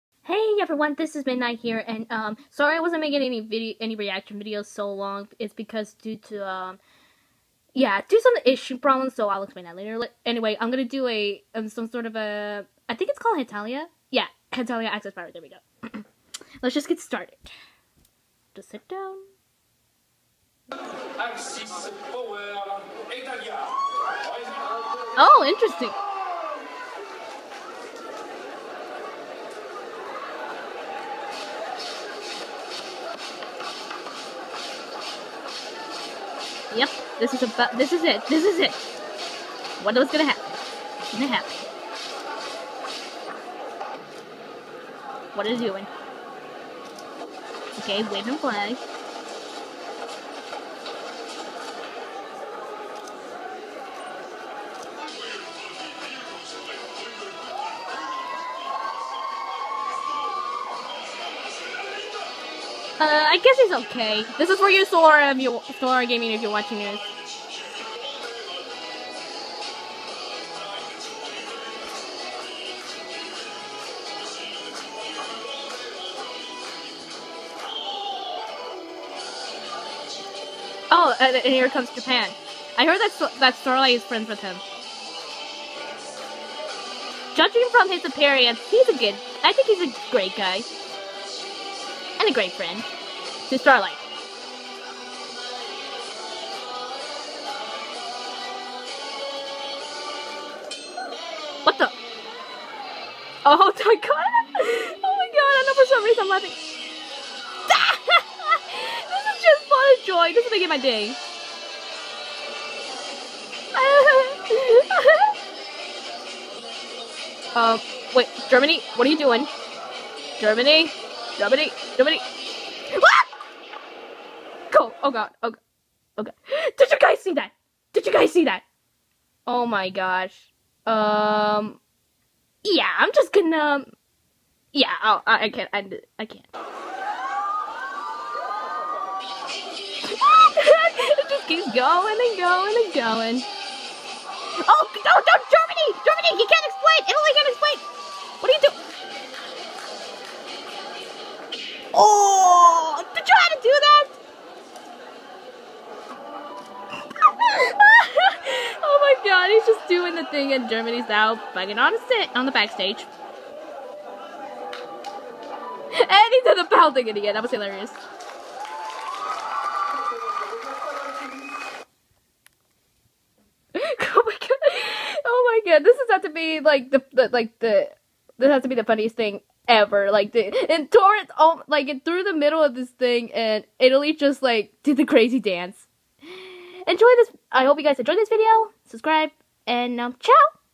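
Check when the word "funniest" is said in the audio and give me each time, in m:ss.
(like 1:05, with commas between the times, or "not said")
2:58.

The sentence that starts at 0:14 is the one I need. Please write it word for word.
Yeah, Hetalia Access Power, there we go.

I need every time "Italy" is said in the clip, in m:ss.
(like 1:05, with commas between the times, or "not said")
2:27, 3:03.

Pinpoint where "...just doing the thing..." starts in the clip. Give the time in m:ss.
2:39.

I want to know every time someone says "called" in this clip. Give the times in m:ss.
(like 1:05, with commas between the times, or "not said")
0:13.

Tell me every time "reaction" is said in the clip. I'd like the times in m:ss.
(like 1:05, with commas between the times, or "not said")
0:03.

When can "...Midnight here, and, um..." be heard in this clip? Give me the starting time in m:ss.
0:01.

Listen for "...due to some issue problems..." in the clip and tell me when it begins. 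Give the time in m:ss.
0:08.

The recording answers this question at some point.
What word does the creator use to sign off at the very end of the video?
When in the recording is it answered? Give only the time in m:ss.
3:10.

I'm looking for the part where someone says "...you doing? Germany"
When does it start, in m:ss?
1:59.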